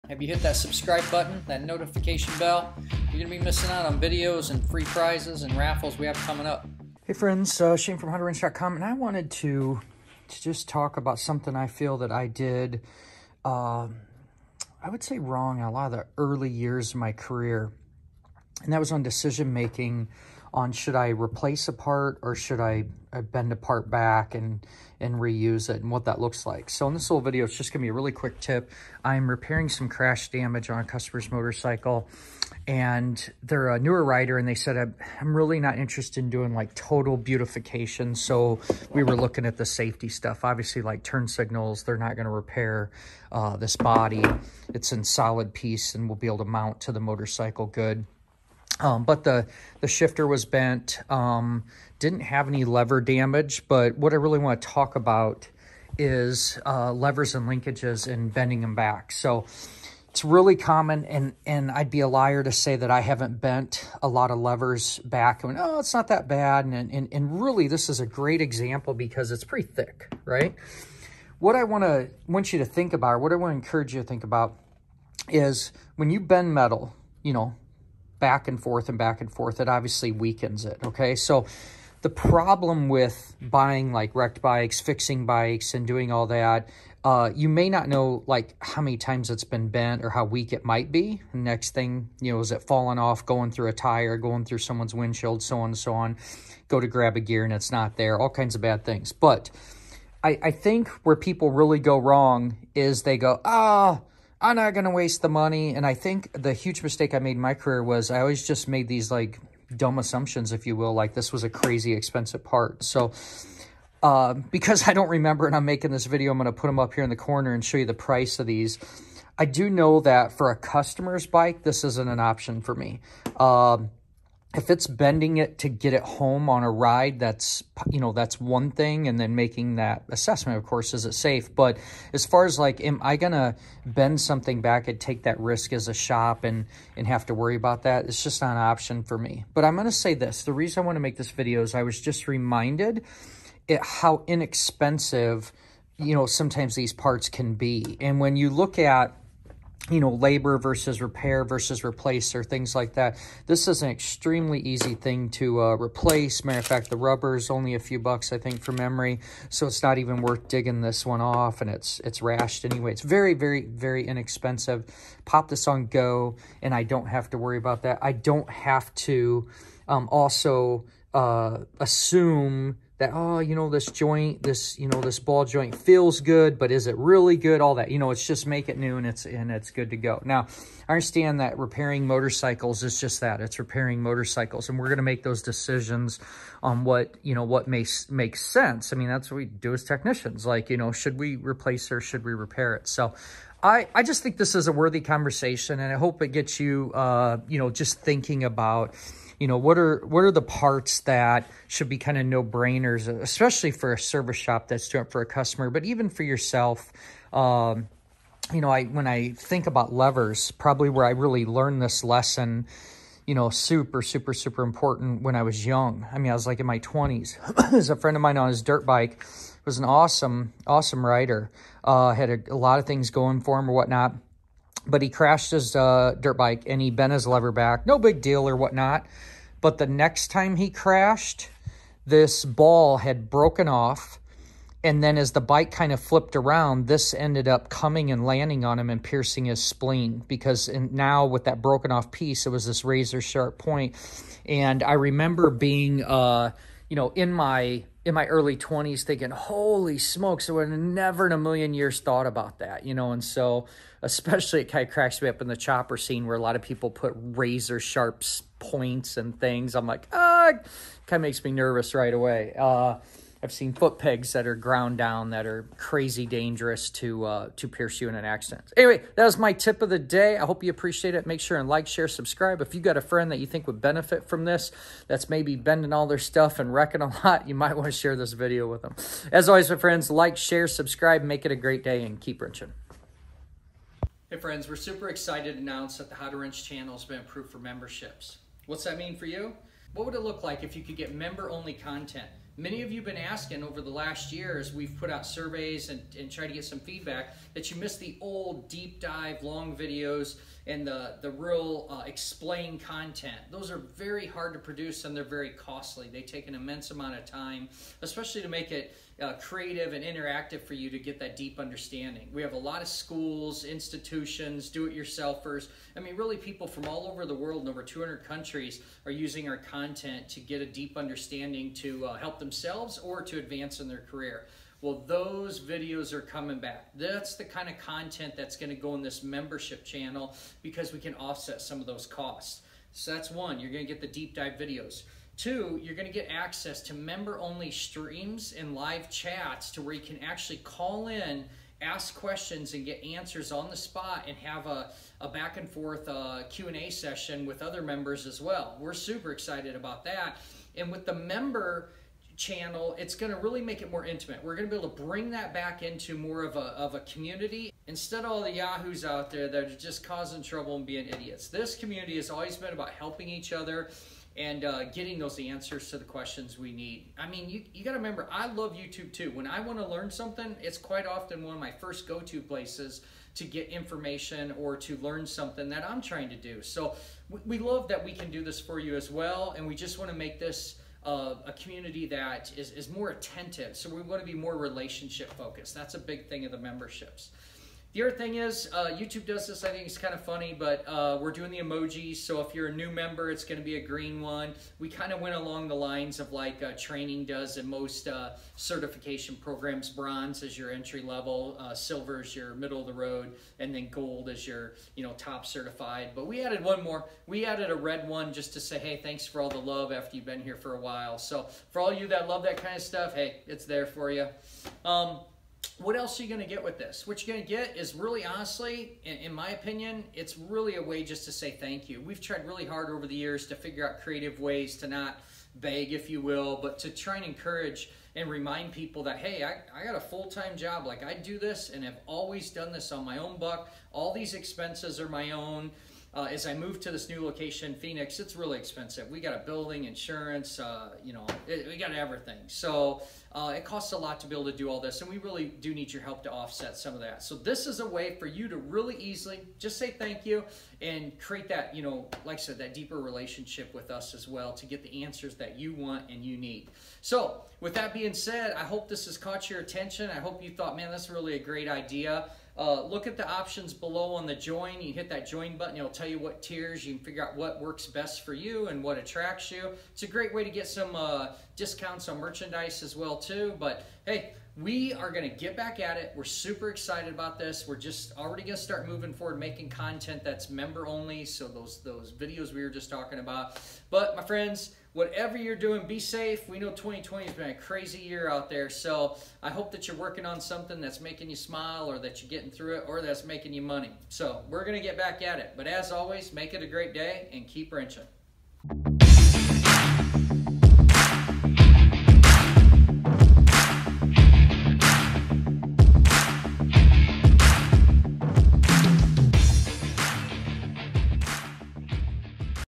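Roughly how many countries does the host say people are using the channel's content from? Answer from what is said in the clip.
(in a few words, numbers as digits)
Over 200.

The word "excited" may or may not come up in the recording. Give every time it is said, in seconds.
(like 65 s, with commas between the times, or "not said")
285 s, 349 s, 476 s.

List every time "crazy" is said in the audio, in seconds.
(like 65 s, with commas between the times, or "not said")
111 s, 265 s, 487 s.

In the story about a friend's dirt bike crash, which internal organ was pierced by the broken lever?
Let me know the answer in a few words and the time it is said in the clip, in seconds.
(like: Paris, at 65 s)
Spleen, at 239 s.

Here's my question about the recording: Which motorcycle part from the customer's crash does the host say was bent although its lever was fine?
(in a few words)
Shifter.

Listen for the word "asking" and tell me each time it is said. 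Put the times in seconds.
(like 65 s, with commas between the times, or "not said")
293 s.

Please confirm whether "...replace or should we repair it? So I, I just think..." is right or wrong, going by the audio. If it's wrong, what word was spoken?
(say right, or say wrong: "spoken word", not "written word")
right.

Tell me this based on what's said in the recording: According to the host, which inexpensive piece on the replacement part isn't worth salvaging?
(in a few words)
The rubber.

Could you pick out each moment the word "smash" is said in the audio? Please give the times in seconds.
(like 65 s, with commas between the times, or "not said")
not said.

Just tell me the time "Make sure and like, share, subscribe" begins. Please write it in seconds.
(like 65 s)
271 s.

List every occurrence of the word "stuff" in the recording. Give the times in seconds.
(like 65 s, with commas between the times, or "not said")
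40 s, 276 s, 412 s.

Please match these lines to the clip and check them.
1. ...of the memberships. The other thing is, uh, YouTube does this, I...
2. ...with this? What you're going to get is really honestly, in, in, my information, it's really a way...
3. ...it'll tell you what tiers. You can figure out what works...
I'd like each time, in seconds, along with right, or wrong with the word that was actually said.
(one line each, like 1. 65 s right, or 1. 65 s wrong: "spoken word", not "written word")
1. 386 s right
2. 416 s wrong: "opinion", not "information"
3. 465 s right.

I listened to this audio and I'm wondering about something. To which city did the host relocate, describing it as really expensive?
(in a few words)
Phoenix.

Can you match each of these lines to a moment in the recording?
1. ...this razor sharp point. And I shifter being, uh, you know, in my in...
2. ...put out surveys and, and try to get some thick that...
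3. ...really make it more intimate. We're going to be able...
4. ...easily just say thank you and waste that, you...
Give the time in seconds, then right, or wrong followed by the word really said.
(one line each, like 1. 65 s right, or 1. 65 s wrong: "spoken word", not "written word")
1. 242 s wrong: "remember", not "shifter"
2. 294 s wrong: "feedback", not "thick"
3. 353 s right
4. 448 s wrong: "create", not "waste".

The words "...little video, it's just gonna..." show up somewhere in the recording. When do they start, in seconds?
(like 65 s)
27 s.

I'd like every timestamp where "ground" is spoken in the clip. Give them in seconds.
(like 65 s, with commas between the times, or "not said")
264 s.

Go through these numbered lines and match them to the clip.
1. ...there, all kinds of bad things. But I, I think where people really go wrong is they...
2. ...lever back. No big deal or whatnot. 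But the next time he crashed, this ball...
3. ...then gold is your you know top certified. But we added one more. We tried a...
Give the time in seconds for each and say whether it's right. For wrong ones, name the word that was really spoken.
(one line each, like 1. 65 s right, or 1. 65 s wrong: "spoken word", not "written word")
1. 97 s right
2. 227 s right
3. 403 s wrong: "added", not "tried".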